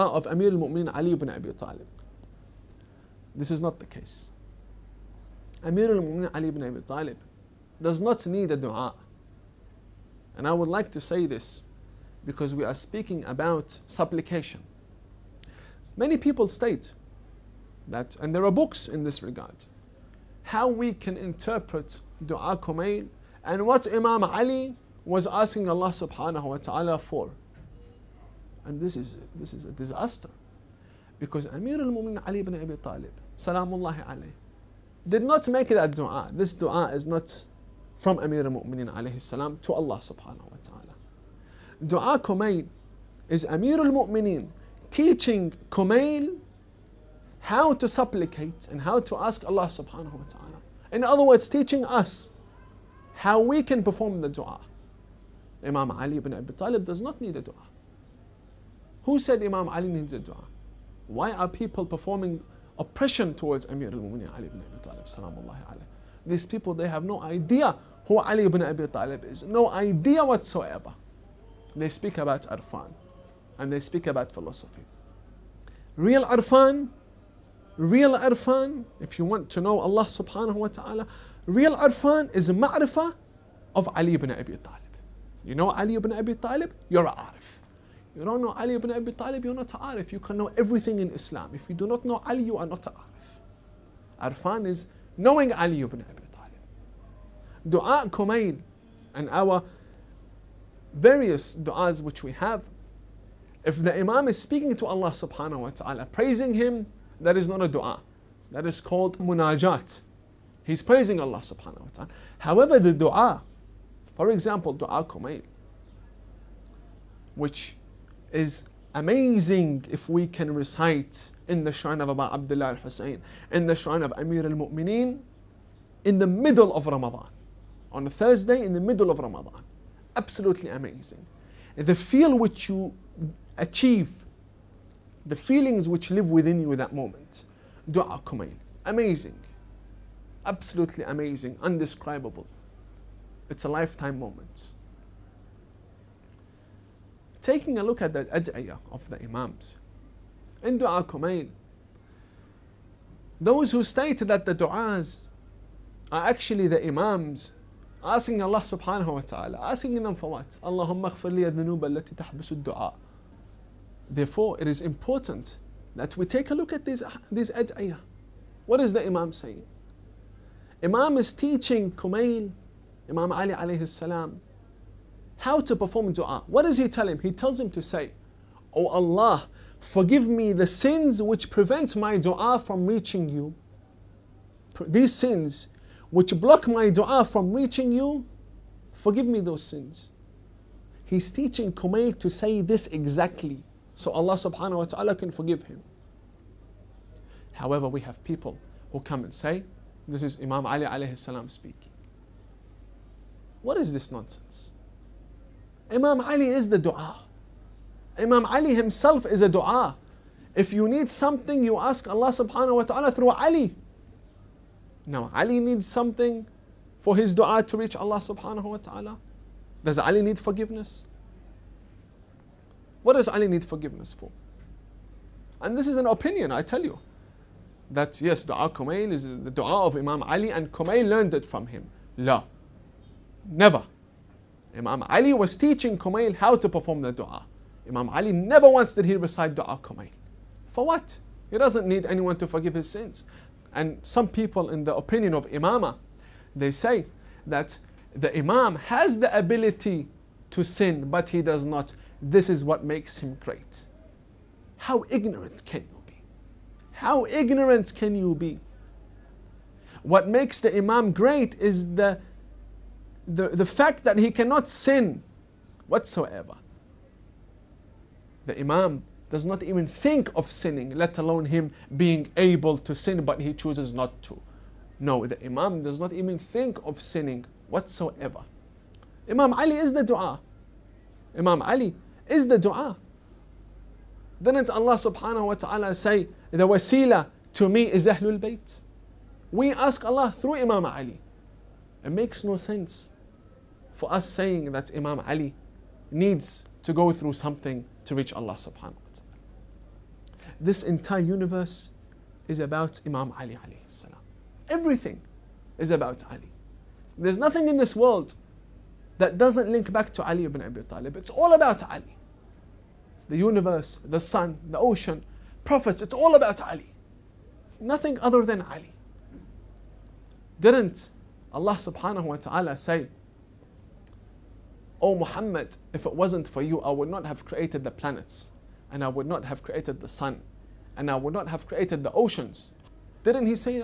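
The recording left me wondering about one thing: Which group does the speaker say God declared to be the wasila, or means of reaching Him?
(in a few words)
Ahlul Bayt.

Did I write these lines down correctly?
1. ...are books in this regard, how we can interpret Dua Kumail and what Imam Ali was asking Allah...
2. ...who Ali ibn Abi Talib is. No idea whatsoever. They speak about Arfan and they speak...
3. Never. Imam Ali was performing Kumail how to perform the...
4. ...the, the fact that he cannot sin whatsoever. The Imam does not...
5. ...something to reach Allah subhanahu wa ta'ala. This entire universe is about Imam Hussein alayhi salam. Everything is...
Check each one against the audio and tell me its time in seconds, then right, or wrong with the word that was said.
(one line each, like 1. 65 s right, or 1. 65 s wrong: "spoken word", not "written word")
1. 18 s right
2. 68 s right
3. 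233 s wrong: "teaching", not "performing"
4. 263 s right
5. 297 s wrong: "Ali", not "Hussein".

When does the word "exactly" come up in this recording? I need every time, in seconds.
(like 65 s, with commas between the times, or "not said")
192 s.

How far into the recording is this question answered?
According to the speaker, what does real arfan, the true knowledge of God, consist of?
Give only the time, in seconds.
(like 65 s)
82 s.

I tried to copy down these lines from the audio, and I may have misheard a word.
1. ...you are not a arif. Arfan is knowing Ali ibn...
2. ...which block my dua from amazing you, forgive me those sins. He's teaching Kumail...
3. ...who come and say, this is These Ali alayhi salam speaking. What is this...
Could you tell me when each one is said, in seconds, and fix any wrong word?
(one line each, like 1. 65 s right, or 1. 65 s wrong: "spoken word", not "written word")
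1. 92 s right
2. 186 s wrong: "reaching", not "amazing"
3. 198 s wrong: "Imam", not "These".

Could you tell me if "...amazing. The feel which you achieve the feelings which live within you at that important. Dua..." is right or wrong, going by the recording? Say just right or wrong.
wrong.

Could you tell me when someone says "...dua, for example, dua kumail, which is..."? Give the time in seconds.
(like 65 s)
112 s.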